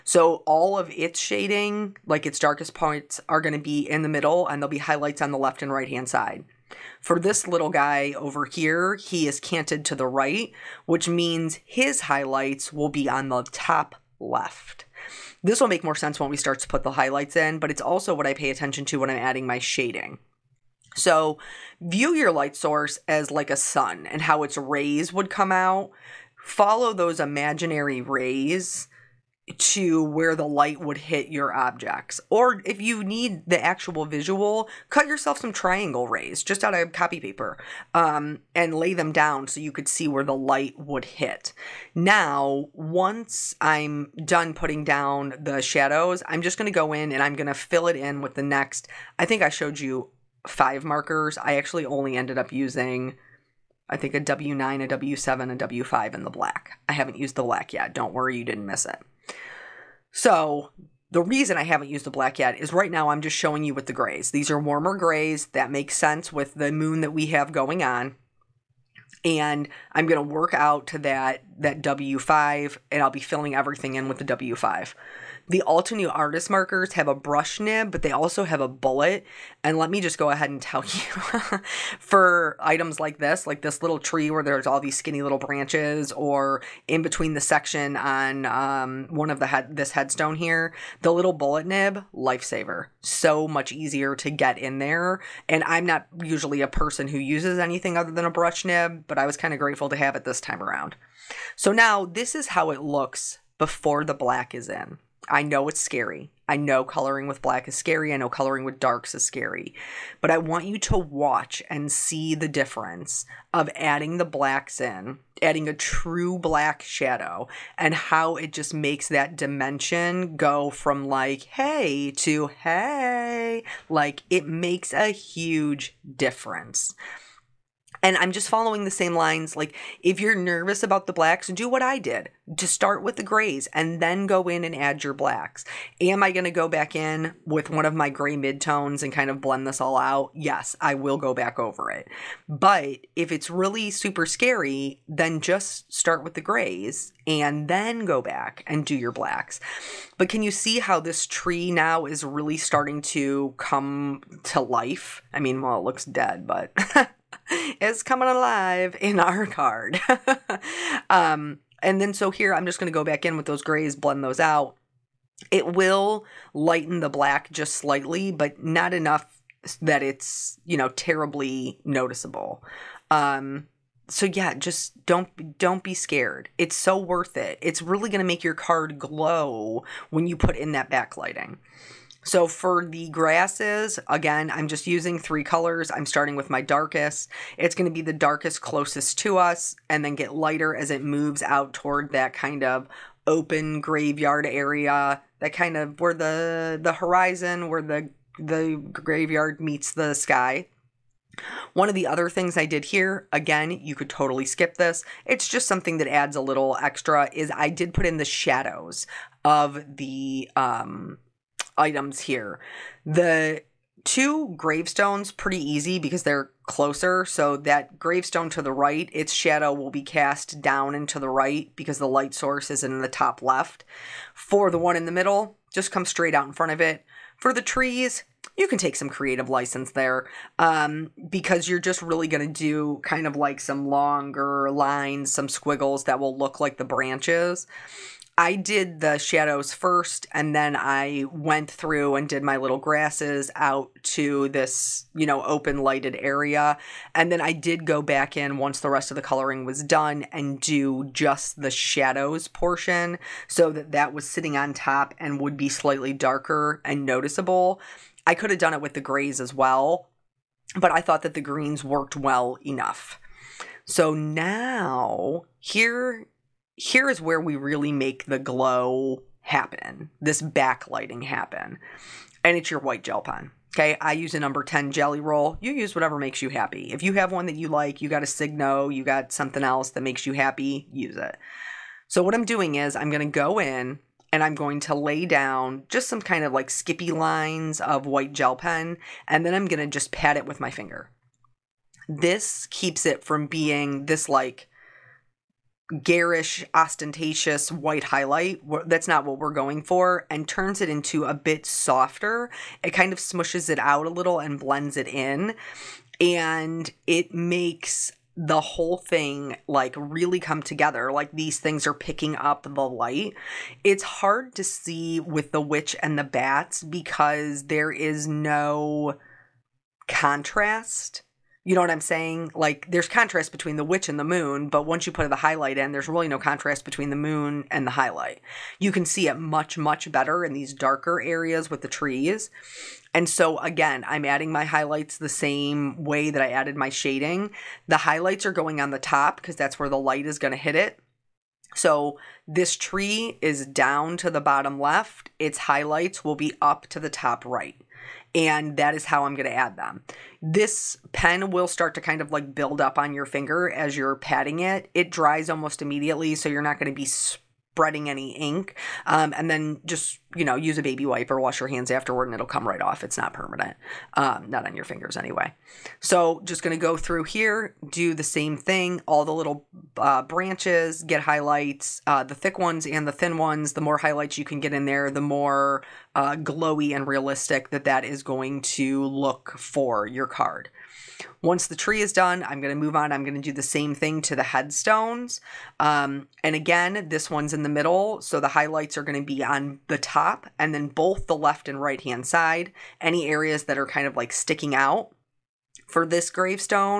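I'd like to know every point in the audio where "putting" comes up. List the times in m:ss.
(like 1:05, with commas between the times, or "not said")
0:44.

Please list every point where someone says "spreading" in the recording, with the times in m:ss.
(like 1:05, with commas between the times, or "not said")
5:57.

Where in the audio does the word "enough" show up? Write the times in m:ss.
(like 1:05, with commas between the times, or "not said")
2:48, 4:22.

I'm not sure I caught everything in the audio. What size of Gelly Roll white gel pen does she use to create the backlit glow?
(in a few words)
number 10.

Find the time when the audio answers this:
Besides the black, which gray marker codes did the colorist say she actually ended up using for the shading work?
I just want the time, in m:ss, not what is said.
0:54.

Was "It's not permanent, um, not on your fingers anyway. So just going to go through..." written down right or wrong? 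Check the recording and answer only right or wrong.
right.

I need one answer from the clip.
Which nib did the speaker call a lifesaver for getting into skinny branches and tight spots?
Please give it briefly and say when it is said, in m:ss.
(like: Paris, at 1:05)
bullet nib, at 1:31.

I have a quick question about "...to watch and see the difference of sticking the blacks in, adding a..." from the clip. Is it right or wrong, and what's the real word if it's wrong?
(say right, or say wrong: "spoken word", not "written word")
wrong: "adding", not "sticking".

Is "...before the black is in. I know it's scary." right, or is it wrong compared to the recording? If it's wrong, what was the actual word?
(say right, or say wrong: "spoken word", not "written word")
right.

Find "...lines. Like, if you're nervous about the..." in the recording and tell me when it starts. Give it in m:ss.
2:09.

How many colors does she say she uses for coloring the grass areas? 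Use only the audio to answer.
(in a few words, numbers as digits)
3.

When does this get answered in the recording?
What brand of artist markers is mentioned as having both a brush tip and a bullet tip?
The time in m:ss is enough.
1:15.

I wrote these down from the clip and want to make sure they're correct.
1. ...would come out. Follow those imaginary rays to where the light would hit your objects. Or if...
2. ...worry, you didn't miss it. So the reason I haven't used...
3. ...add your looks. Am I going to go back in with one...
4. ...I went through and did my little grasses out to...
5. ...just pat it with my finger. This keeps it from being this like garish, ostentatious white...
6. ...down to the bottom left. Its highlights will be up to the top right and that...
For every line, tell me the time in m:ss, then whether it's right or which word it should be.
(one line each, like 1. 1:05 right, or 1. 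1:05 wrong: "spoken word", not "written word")
1. 0:25 right
2. 0:58 right
3. 2:14 wrong: "blacks", not "looks"
4. 4:00 right
5. 4:49 right
6. 5:43 right.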